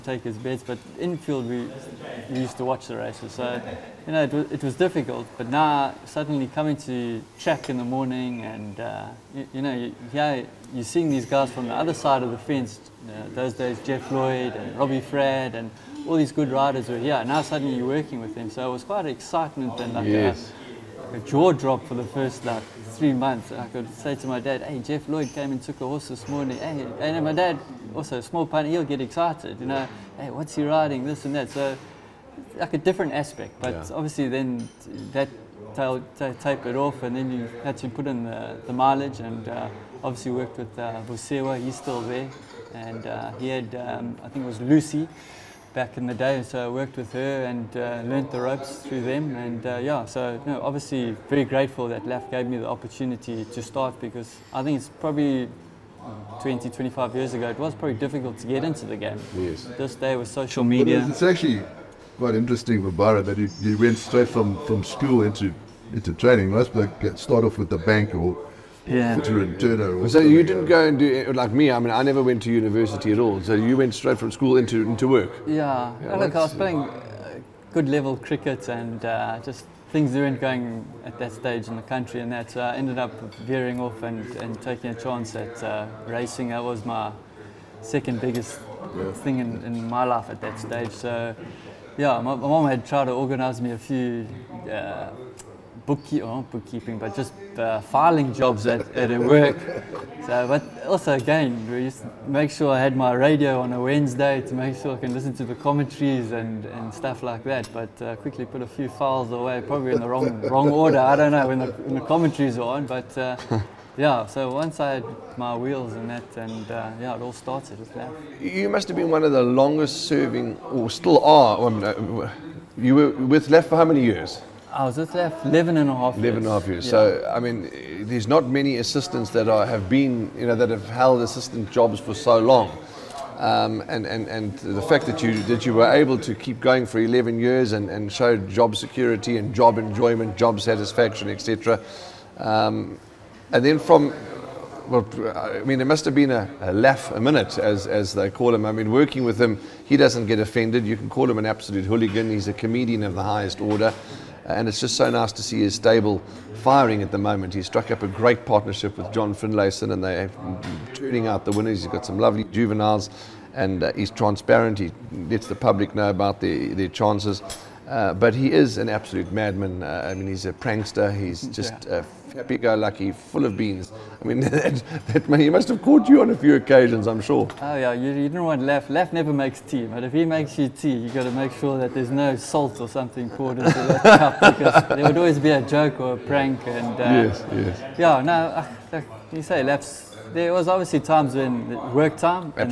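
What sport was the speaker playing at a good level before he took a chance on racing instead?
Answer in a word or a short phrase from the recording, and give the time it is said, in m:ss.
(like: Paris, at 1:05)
Cricket, at 1:18.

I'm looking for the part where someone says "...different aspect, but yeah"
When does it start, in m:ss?
0:32.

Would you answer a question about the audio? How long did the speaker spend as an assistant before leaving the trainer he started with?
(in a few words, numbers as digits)
11 and a half years.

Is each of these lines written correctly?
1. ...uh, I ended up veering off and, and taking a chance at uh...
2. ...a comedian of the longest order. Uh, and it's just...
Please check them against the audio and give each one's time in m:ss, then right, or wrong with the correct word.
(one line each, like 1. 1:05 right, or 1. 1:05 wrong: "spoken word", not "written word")
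1. 1:22 right
2. 2:32 wrong: "highest", not "longest".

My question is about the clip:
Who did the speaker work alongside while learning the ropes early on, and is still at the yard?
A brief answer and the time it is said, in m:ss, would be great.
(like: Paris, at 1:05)
Busewa, at 0:41.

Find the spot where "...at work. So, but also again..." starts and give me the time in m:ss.
1:38.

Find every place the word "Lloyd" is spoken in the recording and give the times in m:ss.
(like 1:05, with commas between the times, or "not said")
0:14, 0:25.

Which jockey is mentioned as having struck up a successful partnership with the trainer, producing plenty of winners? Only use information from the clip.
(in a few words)
John Finlayson.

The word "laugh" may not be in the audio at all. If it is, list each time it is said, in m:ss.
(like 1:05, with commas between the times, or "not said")
2:26, 2:58, 3:09.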